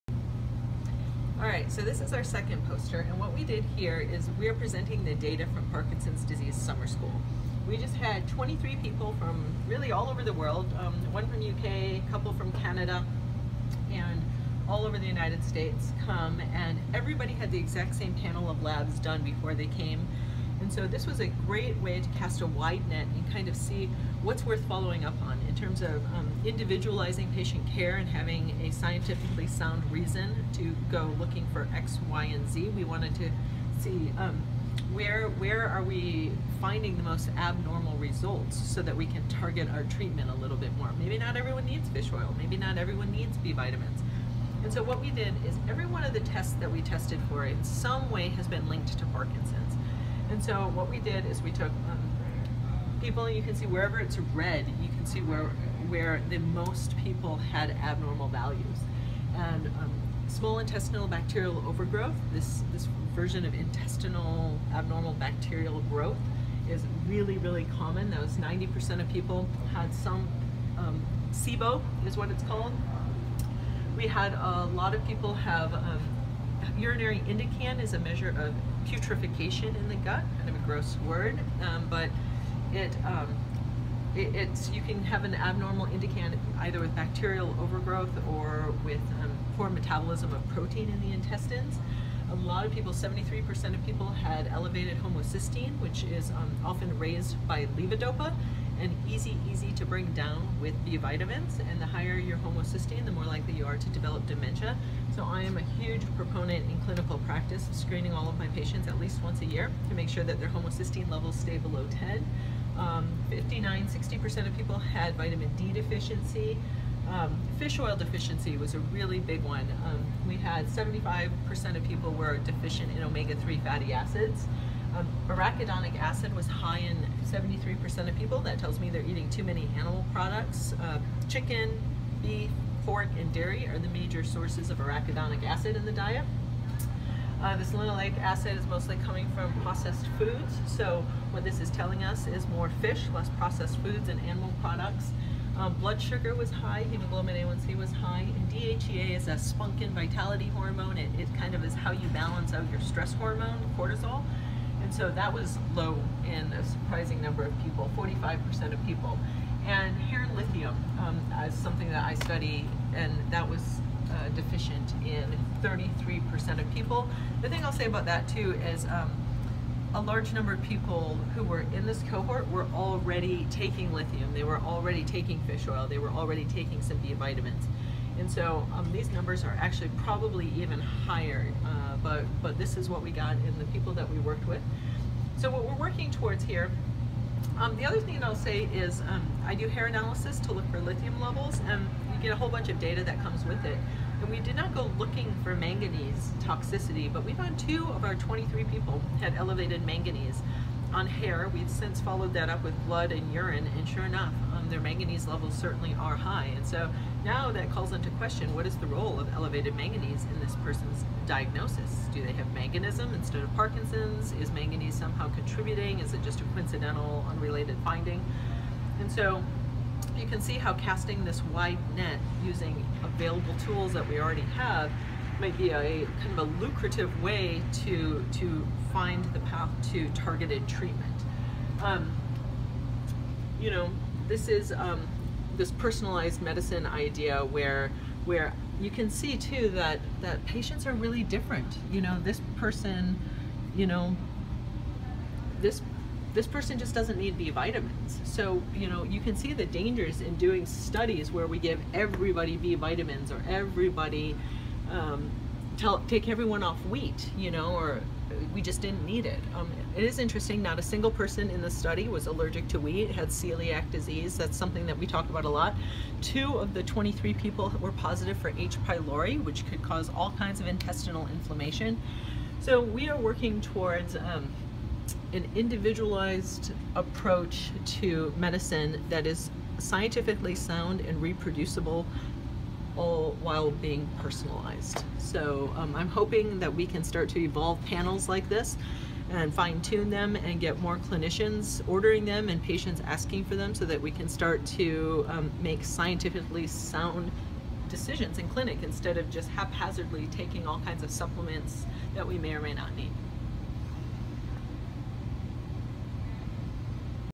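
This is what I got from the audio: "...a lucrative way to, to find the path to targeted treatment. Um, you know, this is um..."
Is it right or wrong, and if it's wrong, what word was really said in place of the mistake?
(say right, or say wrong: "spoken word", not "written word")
right.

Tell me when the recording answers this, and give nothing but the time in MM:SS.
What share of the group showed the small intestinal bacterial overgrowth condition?
01:08.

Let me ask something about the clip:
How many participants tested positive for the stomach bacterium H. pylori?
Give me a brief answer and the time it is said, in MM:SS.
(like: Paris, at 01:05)
2, at 04:26.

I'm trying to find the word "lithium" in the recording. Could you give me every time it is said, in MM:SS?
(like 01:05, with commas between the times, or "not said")
02:40, 02:53, 03:10.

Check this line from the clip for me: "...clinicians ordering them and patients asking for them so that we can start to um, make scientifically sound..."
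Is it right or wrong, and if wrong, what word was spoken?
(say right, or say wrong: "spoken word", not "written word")
right.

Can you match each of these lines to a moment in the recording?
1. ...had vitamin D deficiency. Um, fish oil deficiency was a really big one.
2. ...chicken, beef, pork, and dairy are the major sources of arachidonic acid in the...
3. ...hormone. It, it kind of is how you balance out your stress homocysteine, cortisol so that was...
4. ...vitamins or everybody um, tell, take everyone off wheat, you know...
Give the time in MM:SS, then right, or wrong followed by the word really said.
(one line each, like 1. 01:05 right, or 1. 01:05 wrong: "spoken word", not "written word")
1. 01:54 right
2. 02:11 right
3. 02:30 wrong: "hormone", not "homocysteine"
4. 04:12 right.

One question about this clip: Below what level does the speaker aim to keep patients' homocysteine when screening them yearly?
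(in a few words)
10.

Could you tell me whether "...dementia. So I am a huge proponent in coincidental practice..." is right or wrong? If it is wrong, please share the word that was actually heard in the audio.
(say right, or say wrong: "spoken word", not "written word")
wrong: "clinical", not "coincidental".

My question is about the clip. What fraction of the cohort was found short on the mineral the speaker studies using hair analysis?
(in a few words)
33%.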